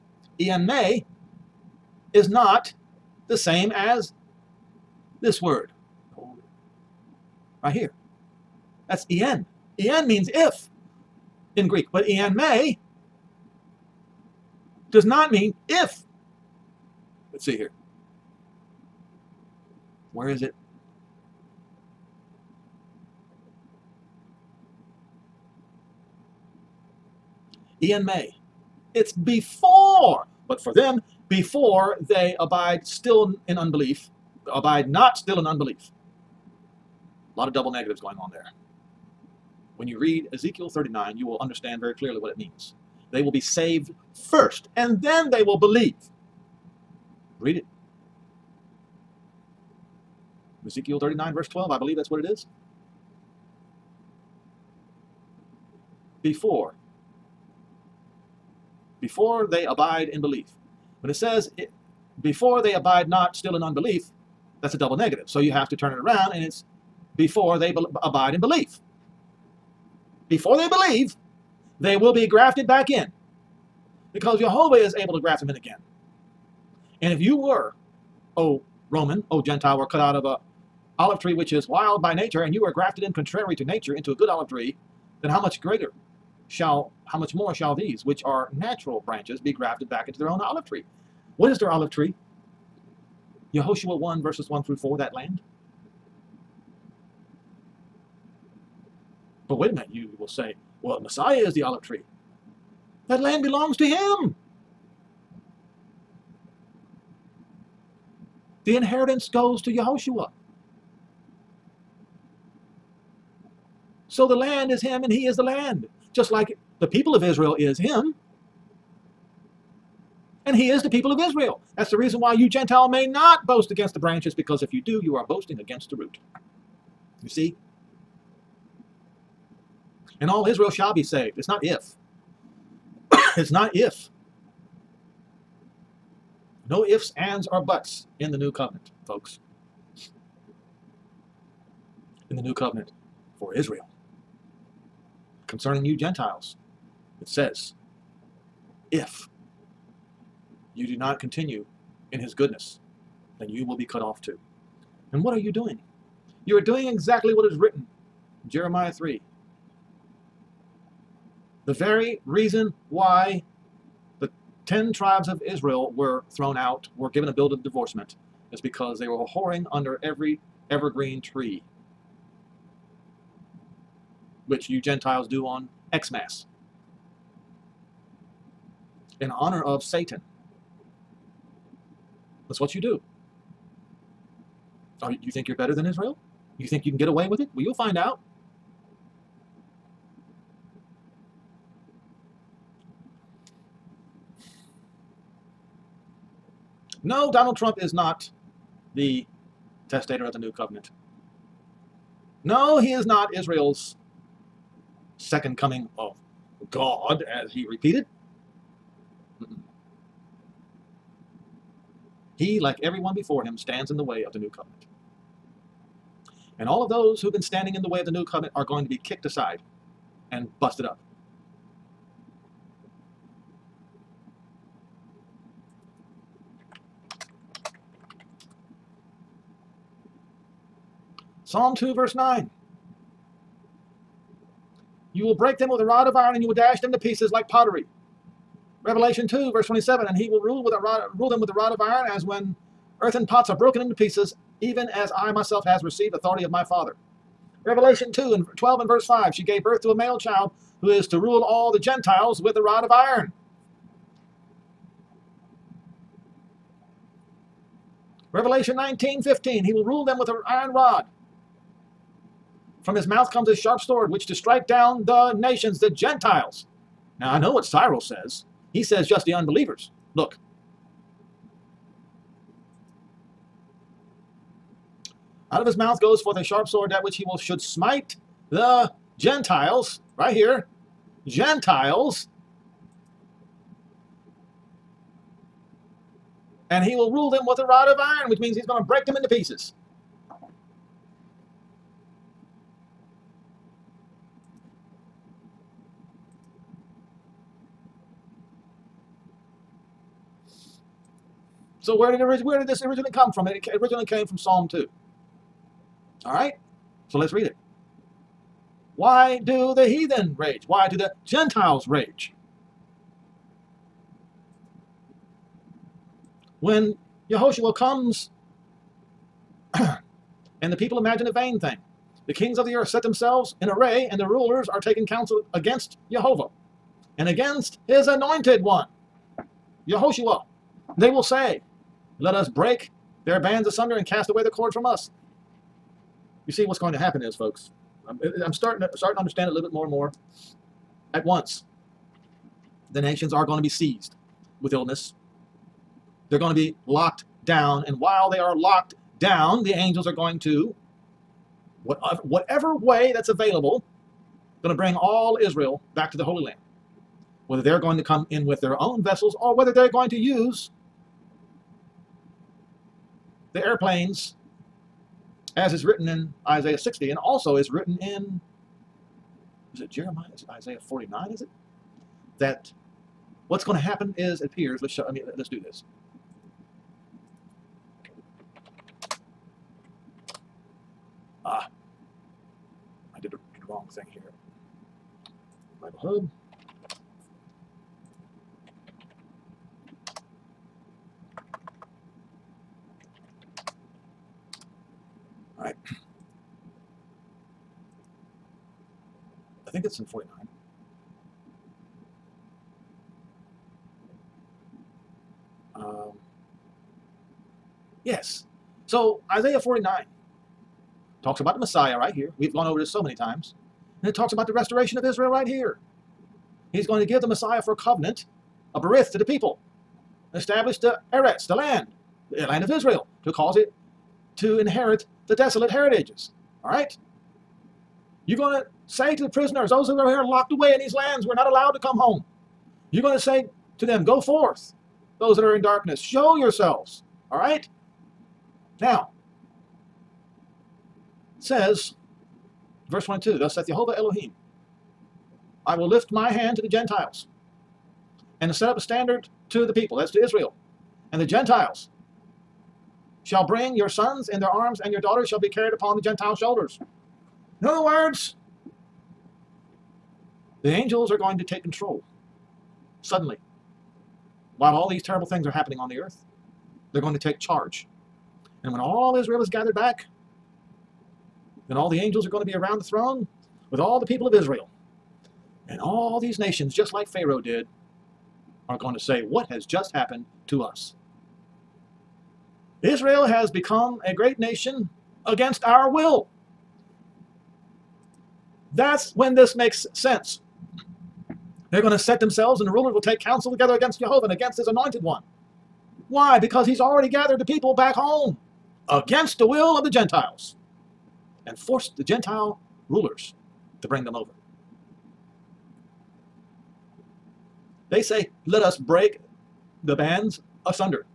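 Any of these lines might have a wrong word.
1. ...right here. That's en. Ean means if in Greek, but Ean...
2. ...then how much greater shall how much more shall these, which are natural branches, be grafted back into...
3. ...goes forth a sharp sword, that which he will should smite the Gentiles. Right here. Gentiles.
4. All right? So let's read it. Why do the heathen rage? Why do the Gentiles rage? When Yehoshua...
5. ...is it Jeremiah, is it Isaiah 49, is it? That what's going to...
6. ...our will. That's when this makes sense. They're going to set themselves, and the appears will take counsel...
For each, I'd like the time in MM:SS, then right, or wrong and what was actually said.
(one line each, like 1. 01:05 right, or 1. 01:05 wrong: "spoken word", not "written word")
1. 00:07 right
2. 01:25 right
3. 04:35 right
4. 05:06 right
5. 06:09 right
6. 08:05 wrong: "rulers", not "appears".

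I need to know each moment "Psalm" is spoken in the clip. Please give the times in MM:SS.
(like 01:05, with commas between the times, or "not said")
03:51, 05:04.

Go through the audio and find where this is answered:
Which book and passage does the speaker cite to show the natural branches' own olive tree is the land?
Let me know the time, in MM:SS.
01:33.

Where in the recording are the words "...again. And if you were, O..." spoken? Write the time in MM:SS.
01:15.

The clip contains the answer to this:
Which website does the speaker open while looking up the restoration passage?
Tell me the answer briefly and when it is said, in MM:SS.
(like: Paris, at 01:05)
Bible Hub, at 06:25.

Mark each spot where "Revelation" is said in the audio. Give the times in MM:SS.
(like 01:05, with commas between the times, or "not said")
03:58, 04:07, 04:18.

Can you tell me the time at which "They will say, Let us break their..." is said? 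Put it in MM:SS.
05:30.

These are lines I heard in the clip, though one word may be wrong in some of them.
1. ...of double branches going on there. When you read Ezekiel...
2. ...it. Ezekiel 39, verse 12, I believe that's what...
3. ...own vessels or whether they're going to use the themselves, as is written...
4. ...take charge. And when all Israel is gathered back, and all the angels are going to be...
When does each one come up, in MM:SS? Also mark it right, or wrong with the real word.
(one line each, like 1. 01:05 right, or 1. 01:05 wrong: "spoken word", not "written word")
1. 00:37 wrong: "negatives", not "branches"
2. 00:47 right
3. 05:58 wrong: "airplanes", not "themselves"
4. 07:47 right.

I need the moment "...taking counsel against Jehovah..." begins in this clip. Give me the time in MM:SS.
05:24.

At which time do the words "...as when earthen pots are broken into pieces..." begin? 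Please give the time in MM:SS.
04:02.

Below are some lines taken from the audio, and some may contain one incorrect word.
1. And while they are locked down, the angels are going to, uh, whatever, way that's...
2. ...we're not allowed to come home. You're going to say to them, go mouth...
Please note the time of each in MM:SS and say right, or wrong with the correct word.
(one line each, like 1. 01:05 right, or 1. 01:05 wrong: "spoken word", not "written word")
1. 05:47 right
2. 07:11 wrong: "forth", not "mouth".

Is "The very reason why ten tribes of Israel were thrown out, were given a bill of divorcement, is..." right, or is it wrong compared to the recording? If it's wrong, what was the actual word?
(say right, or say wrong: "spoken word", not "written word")
right.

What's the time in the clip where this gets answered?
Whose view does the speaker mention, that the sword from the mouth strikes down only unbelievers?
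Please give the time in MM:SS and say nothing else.
04:27.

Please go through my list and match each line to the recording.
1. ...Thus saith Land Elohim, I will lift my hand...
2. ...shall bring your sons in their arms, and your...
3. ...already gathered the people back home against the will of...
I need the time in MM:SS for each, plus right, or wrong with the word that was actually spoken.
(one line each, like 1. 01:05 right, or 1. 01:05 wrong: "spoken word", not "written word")
1. 07:23 wrong: "Jehovah", not "Land"
2. 07:33 right
3. 08:16 right.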